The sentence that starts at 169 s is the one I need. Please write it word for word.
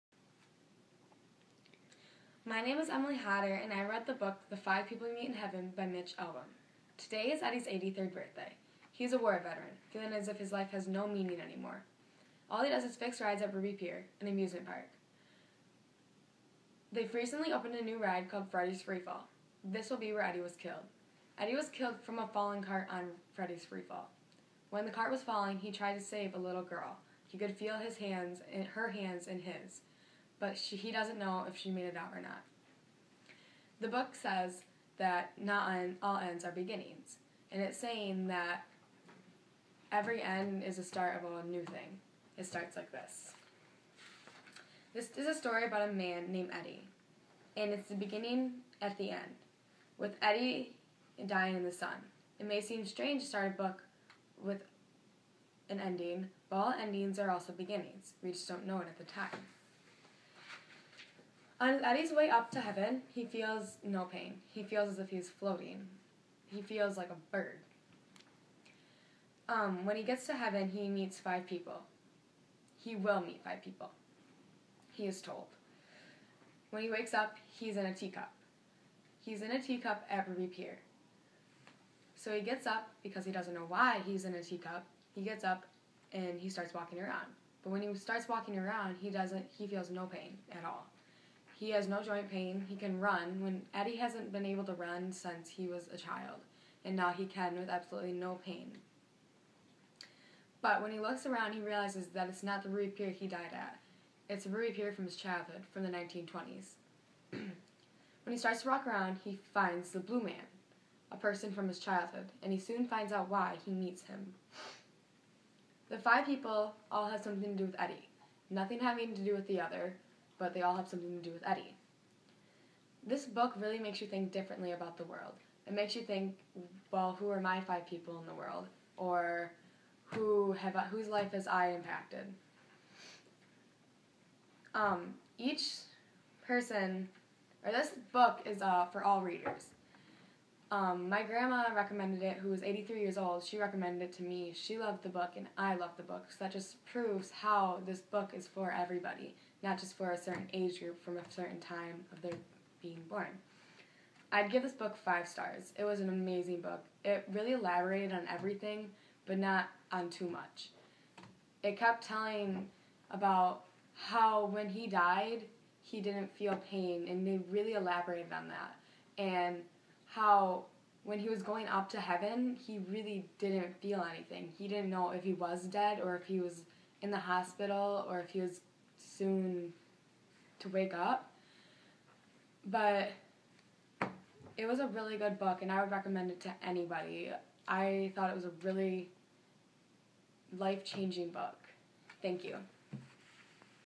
And how when he was going up to heaven, he really didn't feel anything.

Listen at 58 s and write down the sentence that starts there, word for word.
We just don't know it at the time.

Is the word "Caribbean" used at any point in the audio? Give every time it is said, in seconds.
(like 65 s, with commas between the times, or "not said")
not said.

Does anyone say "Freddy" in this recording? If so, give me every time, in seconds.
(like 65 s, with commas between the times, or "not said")
18 s, 23 s.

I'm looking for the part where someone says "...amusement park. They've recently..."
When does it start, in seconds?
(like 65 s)
14 s.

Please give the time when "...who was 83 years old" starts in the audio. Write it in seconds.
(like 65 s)
142 s.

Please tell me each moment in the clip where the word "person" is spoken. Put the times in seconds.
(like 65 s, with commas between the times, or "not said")
111 s, 136 s.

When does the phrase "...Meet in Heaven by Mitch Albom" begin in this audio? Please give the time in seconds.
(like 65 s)
5 s.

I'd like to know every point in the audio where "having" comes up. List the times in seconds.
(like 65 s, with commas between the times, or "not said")
118 s.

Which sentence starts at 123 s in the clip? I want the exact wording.
This book really makes you think differently about the world.